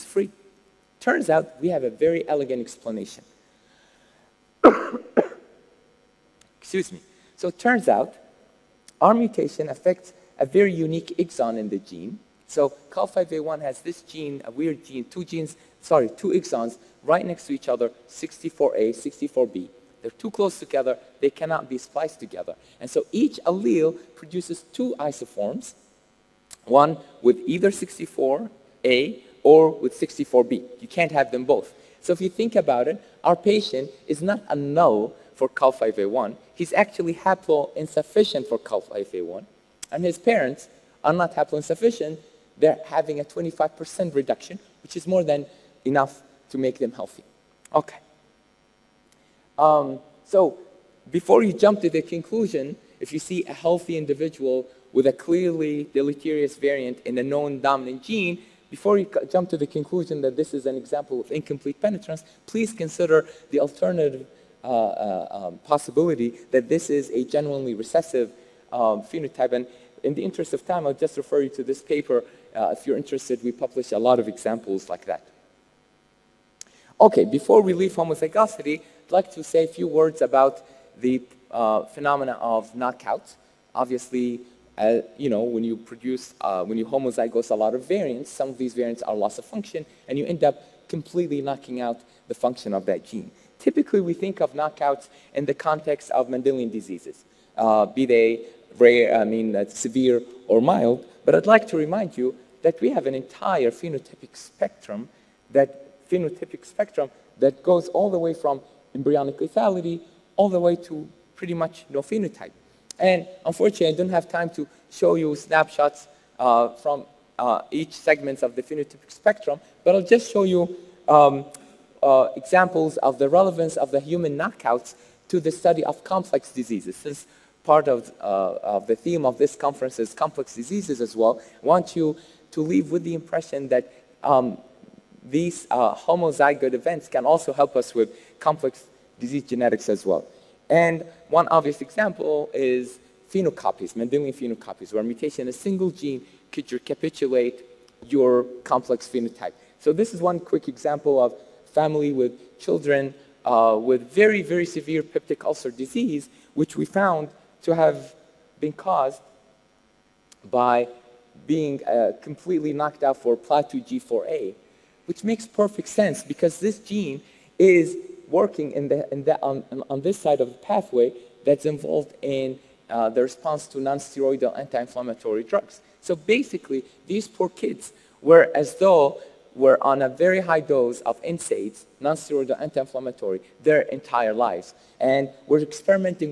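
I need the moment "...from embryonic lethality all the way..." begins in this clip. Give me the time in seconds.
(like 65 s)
108 s.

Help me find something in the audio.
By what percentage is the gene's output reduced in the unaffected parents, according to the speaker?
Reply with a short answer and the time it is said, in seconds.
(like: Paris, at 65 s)
25%, at 43 s.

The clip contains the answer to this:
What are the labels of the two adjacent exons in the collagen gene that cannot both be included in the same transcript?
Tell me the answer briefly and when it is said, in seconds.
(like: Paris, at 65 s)
64A and 64B, at 18 s.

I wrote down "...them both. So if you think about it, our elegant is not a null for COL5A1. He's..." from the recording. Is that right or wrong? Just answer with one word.
wrong.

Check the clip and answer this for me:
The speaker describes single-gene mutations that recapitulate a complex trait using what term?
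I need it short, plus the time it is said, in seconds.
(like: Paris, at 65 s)
Mendelian phenocopies, at 143 s.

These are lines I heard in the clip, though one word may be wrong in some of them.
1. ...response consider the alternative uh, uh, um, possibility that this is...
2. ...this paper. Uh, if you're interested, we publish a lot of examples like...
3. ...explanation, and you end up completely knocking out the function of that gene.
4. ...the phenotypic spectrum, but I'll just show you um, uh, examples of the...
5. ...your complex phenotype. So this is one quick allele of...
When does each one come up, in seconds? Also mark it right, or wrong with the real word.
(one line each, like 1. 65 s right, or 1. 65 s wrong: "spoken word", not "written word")
1. 62 s wrong: "please", not "response"
2. 71 s right
3. 89 s wrong: "function", not "explanation"
4. 118 s right
5. 148 s wrong: "example", not "allele".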